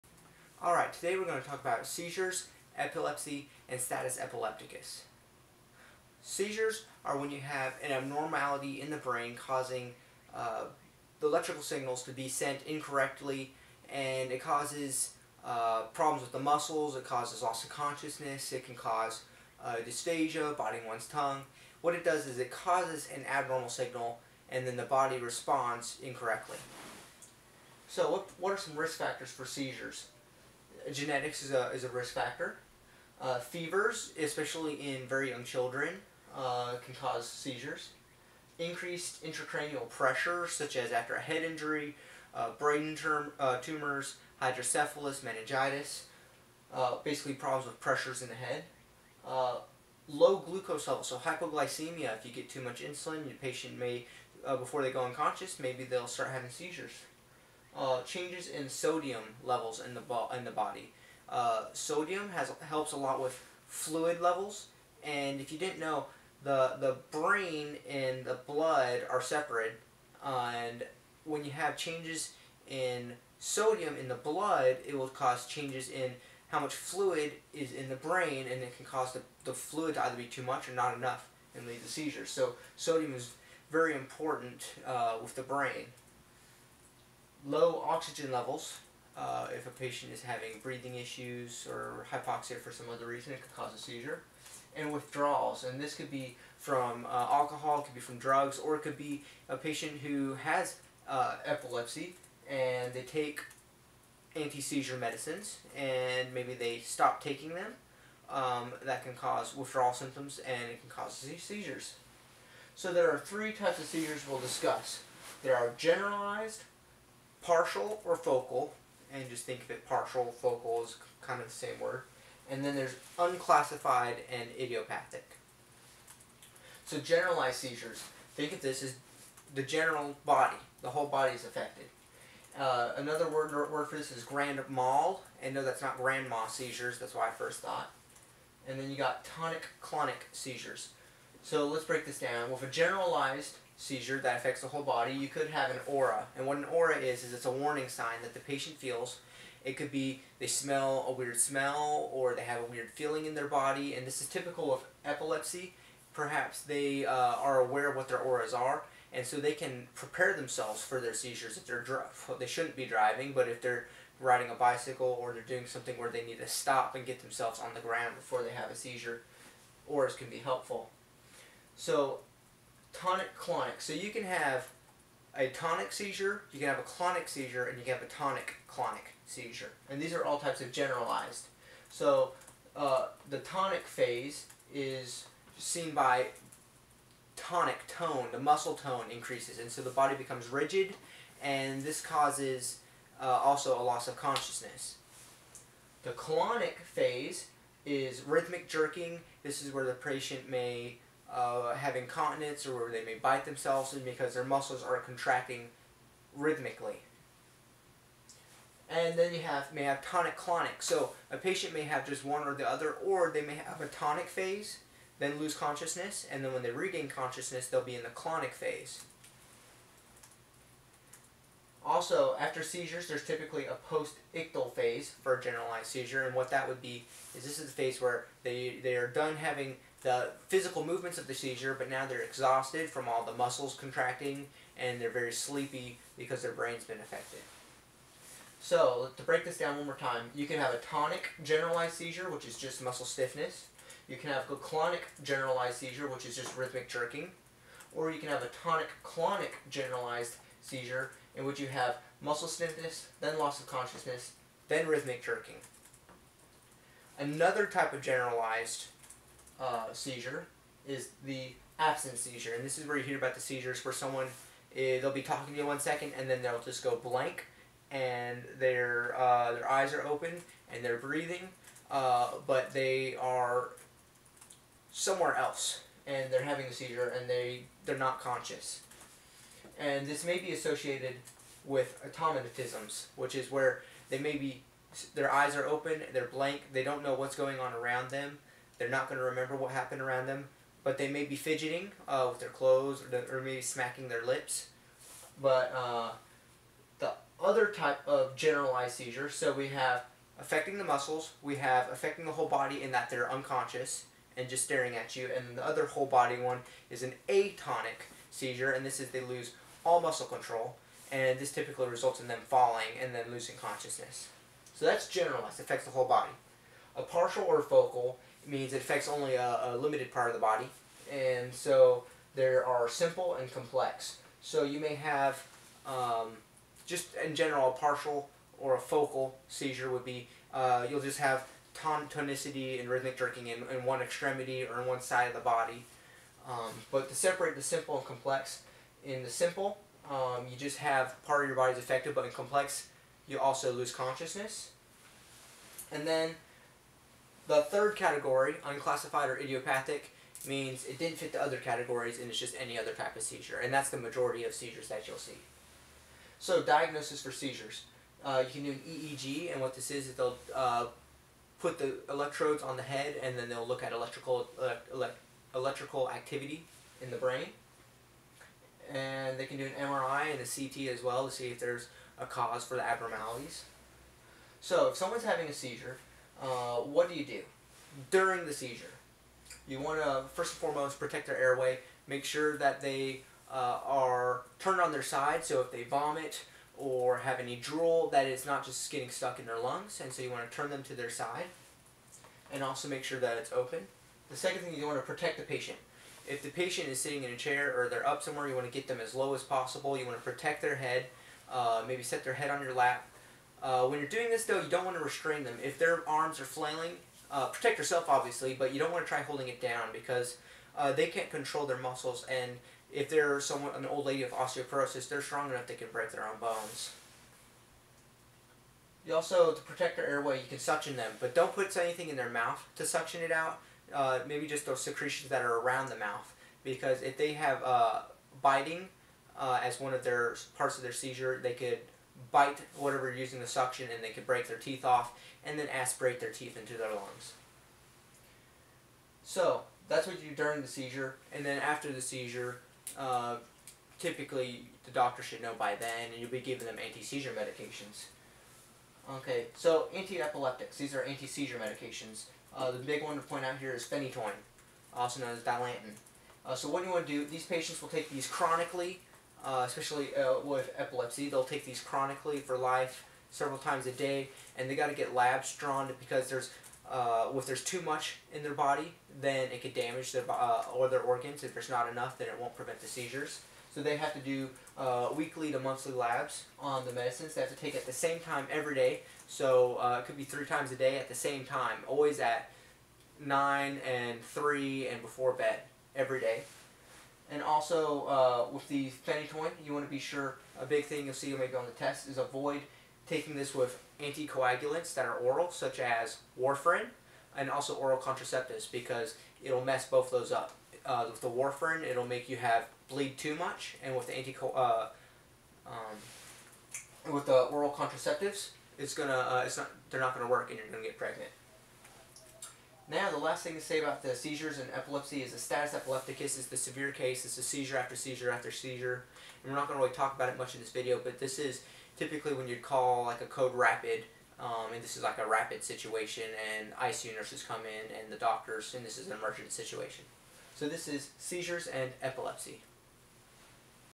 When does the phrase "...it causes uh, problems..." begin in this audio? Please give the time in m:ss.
0:14.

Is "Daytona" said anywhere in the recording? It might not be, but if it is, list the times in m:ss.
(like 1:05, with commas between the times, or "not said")
not said.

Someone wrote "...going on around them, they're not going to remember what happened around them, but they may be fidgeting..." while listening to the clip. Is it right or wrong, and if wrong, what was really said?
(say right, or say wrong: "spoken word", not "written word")
right.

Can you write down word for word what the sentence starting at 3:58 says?
So, to break this down one more time, you can have a tonic generalized seizure, which is just muscle stiffness.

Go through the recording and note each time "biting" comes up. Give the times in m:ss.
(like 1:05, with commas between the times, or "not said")
0:20, 7:08.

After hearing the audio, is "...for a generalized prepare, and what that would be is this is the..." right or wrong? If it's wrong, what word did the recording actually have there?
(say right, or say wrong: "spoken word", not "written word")
wrong: "seizure", not "prepare".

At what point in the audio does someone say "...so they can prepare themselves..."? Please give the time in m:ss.
2:39.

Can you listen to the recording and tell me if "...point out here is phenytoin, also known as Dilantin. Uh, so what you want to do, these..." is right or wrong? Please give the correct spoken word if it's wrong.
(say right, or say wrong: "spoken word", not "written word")
right.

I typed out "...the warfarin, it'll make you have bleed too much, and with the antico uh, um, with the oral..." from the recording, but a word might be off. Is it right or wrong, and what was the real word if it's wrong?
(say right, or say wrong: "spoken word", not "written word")
right.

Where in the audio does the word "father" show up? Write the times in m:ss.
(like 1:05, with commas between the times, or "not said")
not said.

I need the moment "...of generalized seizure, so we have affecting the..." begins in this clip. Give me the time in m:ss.
4:58.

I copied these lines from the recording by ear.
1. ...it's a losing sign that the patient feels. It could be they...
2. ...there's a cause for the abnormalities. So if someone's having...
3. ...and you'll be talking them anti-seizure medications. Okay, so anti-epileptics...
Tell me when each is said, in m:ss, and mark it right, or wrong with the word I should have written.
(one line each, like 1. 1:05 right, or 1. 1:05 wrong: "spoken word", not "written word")
1. 2:27 wrong: "warning", not "losing"
2. 6:11 right
3. 7:26 wrong: "giving", not "talking".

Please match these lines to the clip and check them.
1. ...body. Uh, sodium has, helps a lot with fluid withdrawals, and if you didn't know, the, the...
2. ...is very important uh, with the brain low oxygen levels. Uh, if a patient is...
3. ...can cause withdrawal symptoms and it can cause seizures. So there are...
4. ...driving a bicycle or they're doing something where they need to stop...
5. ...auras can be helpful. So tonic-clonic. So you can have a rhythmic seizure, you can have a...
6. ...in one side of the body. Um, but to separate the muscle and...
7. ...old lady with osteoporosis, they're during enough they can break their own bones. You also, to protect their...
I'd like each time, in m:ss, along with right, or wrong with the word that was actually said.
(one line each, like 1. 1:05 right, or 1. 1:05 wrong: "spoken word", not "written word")
1. 1:00 wrong: "levels", not "withdrawals"
2. 1:23 right
3. 1:49 right
4. 2:44 wrong: "riding", not "driving"
5. 2:49 wrong: "tonic", not "rhythmic"
6. 5:34 wrong: "simple", not "muscle"
7. 6:53 wrong: "strong", not "during".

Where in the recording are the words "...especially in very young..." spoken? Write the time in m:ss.
0:34.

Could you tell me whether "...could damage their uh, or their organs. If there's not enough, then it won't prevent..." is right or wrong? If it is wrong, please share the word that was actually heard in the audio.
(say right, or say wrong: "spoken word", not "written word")
right.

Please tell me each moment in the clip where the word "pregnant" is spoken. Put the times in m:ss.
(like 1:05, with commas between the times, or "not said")
8:30.